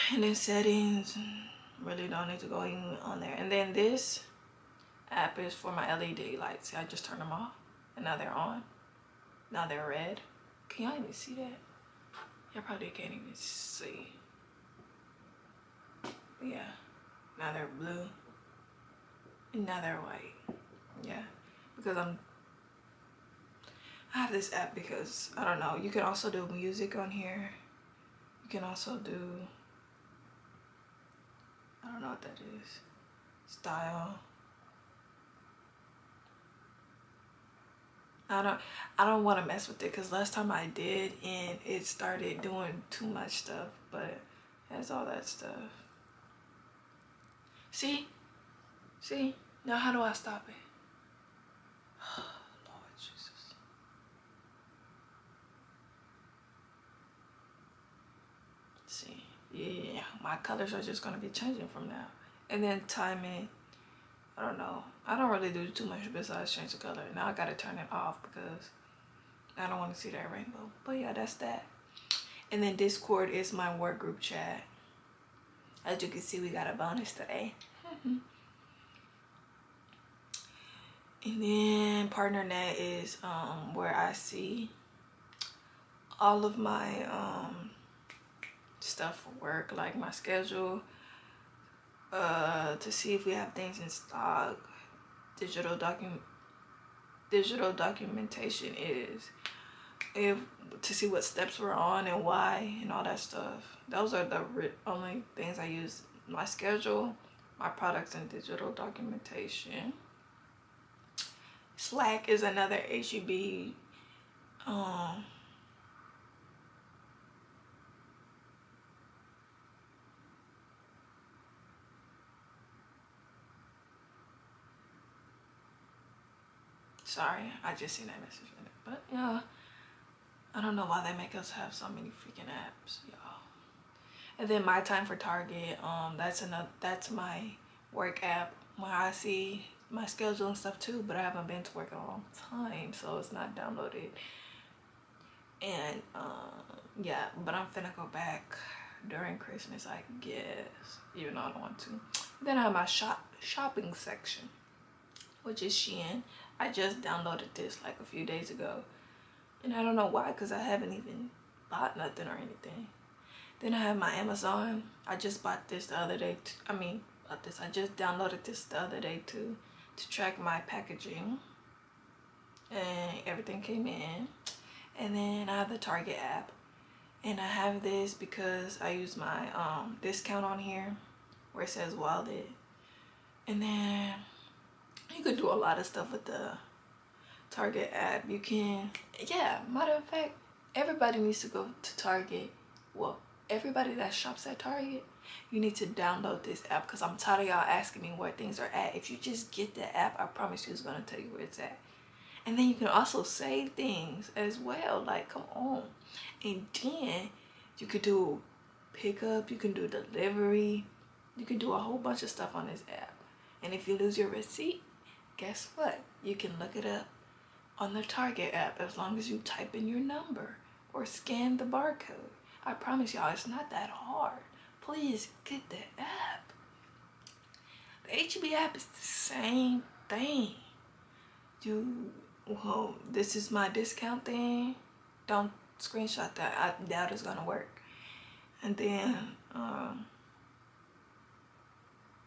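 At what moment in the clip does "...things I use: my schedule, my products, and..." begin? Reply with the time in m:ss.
1:45.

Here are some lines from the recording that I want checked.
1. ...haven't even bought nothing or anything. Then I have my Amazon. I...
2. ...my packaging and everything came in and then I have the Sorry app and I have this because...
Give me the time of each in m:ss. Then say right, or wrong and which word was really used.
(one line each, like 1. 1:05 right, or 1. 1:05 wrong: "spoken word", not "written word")
1. 2:40 right
2. 2:50 wrong: "Target", not "Sorry".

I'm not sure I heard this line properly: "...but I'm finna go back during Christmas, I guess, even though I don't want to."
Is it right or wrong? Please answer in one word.
right.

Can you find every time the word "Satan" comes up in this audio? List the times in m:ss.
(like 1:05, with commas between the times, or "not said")
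not said.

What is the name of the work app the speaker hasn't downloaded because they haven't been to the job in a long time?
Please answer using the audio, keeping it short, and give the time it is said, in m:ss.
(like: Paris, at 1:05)
myTime, at 2:14.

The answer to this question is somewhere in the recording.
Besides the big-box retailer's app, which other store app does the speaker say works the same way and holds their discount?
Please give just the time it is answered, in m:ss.
3:48.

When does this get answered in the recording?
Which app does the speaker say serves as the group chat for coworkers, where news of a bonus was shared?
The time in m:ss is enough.
1:12.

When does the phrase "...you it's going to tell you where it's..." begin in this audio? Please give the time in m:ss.
3:20.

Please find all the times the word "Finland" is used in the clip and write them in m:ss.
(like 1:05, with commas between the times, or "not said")
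not said.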